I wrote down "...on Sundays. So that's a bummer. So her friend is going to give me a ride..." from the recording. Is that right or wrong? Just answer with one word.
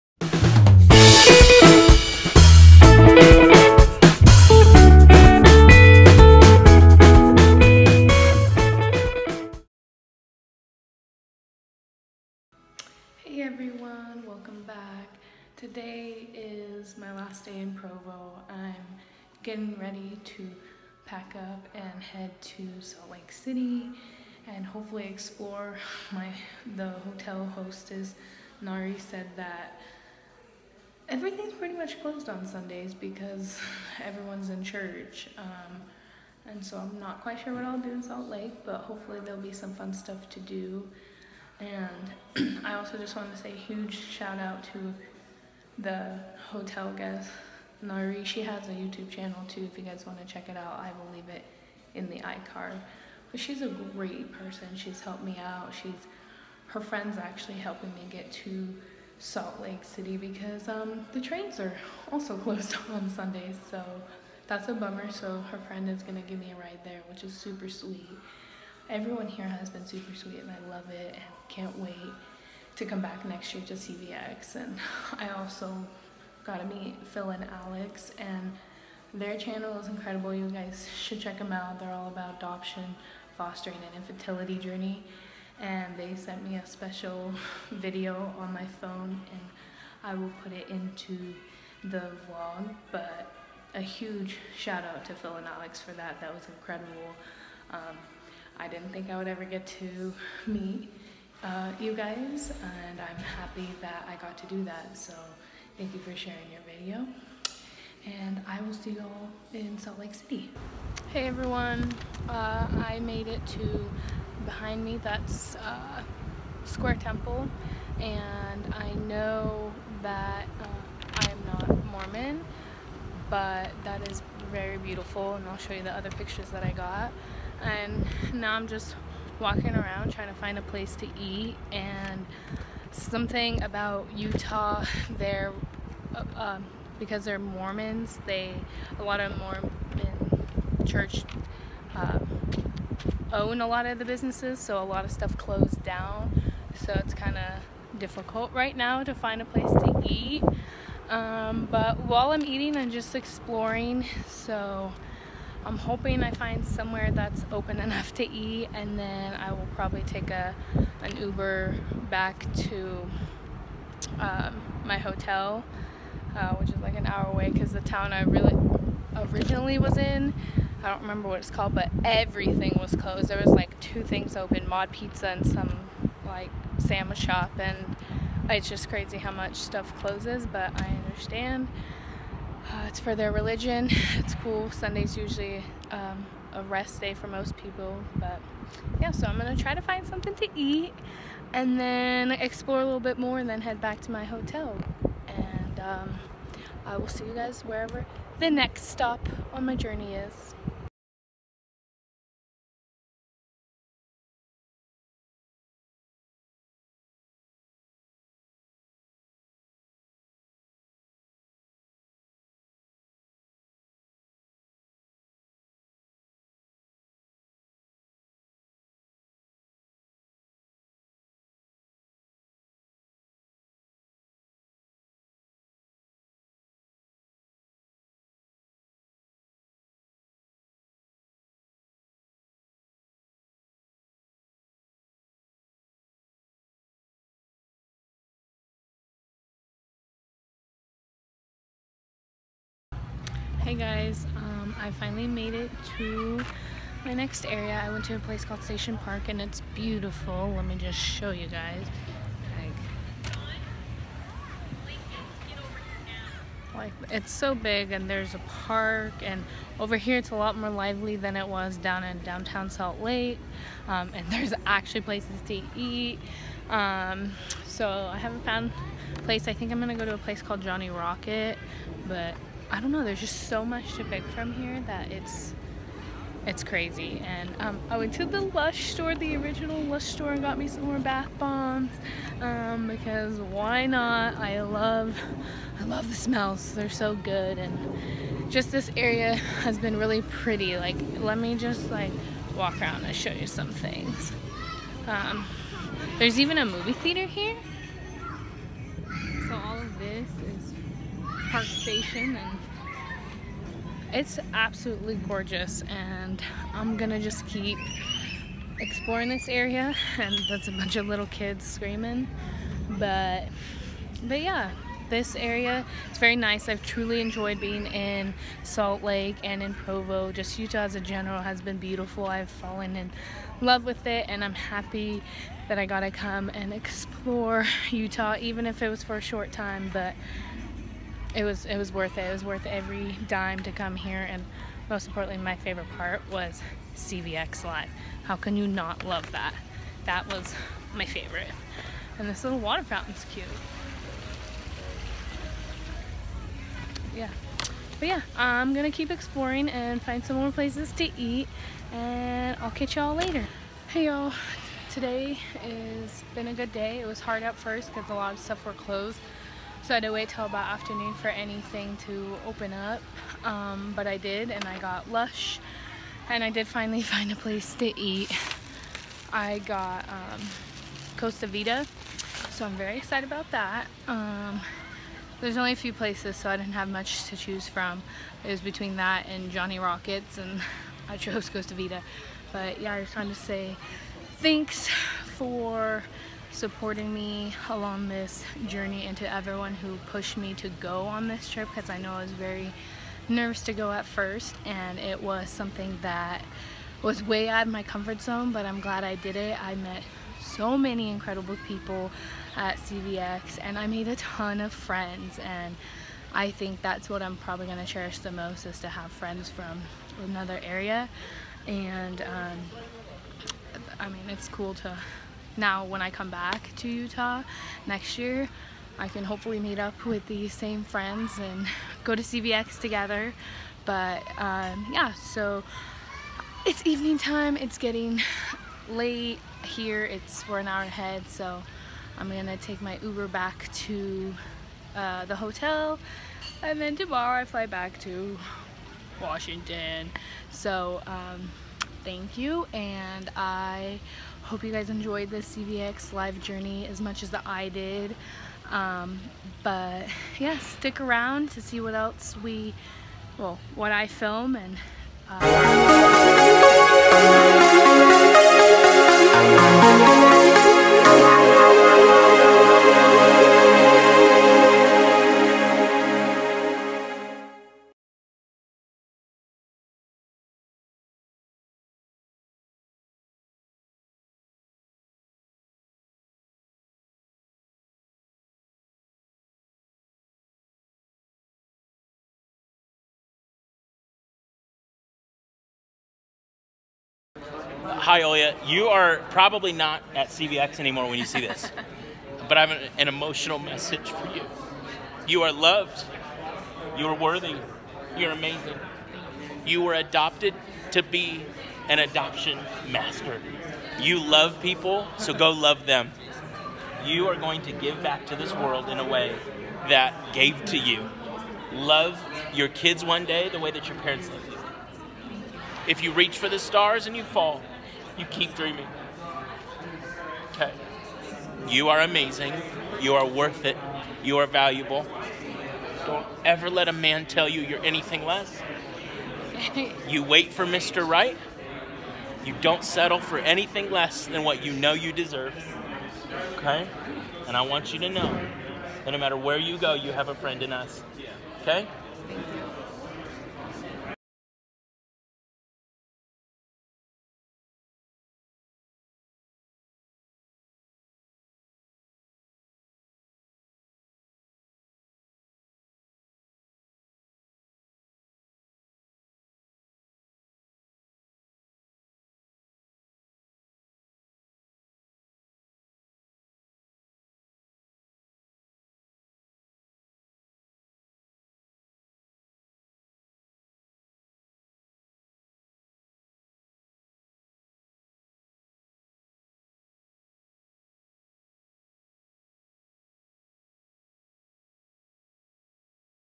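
right.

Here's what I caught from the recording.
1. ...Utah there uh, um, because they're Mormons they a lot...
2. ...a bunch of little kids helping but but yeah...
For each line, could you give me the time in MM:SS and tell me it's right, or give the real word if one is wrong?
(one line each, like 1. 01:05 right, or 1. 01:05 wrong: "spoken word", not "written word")
1. 02:14 right
2. 05:10 wrong: "screaming", not "helping".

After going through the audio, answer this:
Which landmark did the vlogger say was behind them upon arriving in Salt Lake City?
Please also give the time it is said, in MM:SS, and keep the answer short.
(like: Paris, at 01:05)
Square Temple, at 01:56.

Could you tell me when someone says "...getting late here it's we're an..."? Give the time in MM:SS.
07:07.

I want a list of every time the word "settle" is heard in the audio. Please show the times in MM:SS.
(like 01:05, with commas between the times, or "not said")
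08:52.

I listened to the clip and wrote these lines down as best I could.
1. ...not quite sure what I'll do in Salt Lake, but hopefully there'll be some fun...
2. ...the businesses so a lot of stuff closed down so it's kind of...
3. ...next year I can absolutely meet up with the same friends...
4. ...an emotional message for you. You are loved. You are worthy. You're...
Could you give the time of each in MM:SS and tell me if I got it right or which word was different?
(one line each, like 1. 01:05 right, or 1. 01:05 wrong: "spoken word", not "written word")
1. 00:36 right
2. 02:23 right
3. 06:57 wrong: "hopefully", not "absolutely"
4. 08:12 right.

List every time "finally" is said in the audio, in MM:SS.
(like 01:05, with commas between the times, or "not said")
04:04, 06:06.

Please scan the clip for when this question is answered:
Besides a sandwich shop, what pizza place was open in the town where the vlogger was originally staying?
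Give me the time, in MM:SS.
02:54.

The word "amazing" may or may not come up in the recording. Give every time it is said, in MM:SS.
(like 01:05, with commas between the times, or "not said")
08:18, 08:42.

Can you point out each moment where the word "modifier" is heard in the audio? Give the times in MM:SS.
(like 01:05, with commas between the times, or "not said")
not said.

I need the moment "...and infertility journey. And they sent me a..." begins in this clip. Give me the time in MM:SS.
01:23.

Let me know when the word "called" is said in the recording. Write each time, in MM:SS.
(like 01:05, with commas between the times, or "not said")
02:51, 04:08, 04:30.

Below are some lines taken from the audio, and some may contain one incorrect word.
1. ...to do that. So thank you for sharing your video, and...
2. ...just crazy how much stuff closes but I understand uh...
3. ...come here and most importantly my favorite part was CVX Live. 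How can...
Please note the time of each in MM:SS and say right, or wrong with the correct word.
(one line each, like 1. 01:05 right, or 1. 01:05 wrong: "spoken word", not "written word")
1. 01:44 right
2. 02:58 right
3. 05:33 right.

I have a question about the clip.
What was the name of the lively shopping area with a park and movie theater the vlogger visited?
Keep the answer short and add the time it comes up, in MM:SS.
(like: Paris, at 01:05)
Station Park, at 04:08.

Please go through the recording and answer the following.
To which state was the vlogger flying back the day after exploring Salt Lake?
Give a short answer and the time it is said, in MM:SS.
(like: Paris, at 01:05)
Washington, at 07:19.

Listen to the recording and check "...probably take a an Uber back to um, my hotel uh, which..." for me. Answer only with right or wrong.
right.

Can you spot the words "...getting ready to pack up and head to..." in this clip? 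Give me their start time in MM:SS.
00:19.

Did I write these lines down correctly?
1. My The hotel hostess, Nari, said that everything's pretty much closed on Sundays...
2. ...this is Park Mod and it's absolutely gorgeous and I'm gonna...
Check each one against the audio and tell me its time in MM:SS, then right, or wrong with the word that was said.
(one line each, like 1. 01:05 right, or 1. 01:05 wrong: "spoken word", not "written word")
1. 00:26 right
2. 04:59 wrong: "Station", not "Mod".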